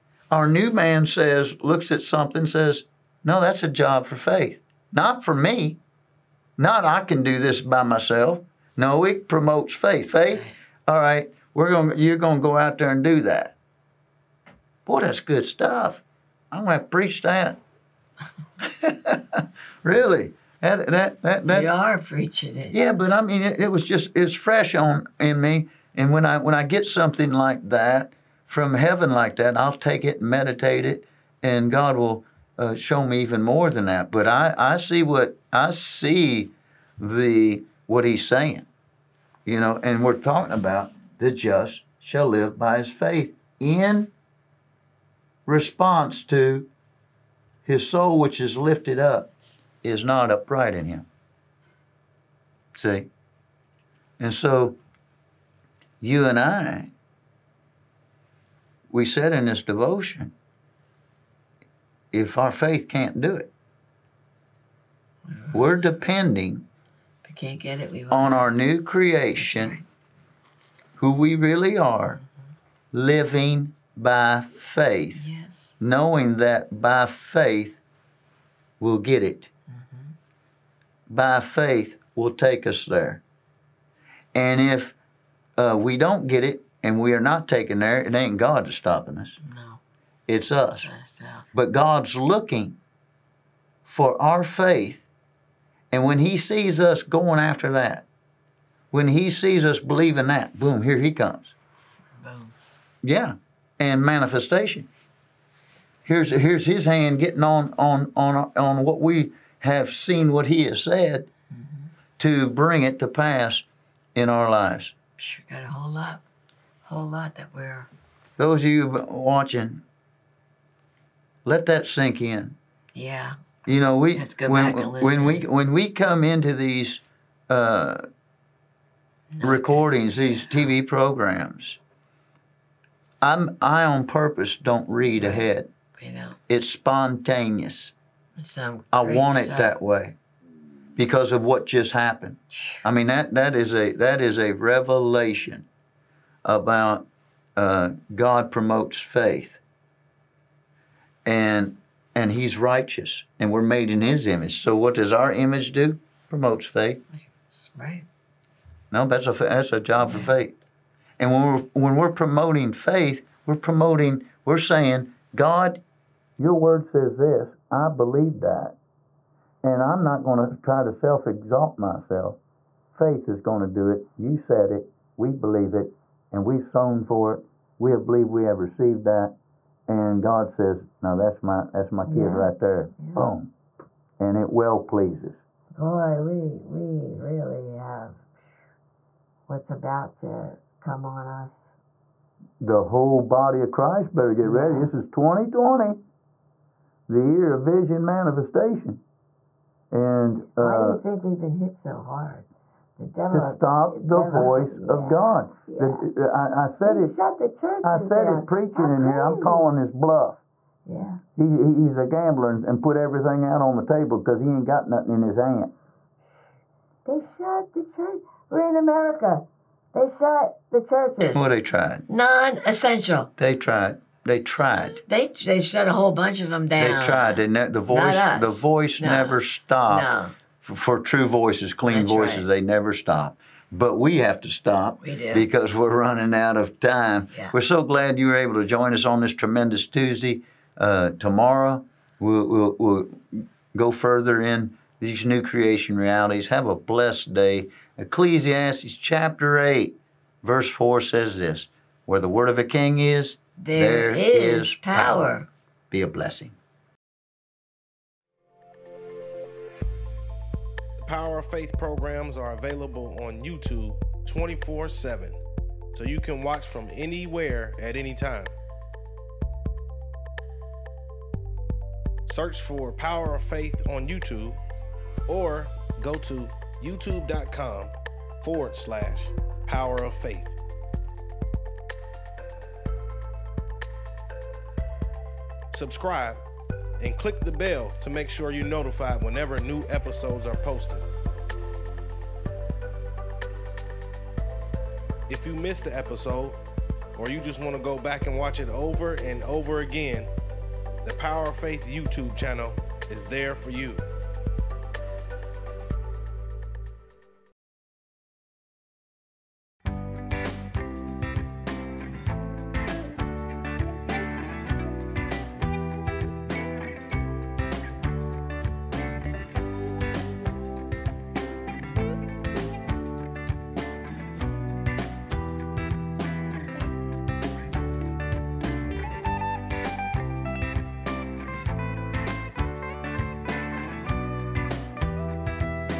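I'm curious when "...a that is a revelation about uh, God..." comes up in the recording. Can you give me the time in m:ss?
2:23.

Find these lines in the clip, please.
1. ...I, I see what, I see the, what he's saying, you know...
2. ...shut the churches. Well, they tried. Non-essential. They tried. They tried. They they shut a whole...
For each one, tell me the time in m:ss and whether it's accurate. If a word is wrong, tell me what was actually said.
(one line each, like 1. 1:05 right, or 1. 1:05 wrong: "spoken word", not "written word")
1. 0:34 right
2. 3:40 right.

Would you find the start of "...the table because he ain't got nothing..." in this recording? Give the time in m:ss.
3:33.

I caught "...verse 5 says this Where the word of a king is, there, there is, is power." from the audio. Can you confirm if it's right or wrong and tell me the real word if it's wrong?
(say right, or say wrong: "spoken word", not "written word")
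wrong: "4", not "5".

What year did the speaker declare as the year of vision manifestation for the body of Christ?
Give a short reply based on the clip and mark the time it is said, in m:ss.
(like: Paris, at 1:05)
2020, at 3:15.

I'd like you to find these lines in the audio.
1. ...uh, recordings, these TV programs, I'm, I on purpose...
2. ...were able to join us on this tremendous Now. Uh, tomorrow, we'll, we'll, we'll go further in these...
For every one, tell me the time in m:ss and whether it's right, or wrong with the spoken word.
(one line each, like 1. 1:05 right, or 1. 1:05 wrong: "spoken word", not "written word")
1. 2:07 right
2. 3:58 wrong: "Tuesday", not "Now".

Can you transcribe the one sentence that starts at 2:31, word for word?
And and he's righteous and we're made in his image.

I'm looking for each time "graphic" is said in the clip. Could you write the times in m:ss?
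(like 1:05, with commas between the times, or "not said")
not said.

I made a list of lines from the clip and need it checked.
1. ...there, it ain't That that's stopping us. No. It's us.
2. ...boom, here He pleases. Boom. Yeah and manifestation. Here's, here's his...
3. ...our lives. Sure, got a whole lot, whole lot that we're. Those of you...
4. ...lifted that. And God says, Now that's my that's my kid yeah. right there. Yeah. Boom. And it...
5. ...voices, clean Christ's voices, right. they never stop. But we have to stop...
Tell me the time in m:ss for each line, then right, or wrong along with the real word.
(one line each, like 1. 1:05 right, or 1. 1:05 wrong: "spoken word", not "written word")
1. 1:27 wrong: "God", not "That"
2. 1:40 wrong: "comes", not "pleases"
3. 1:54 right
4. 2:58 wrong: "received", not "lifted"
5. 3:51 wrong: "That", not "Christ".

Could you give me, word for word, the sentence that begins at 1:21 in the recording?
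By faith will take us there.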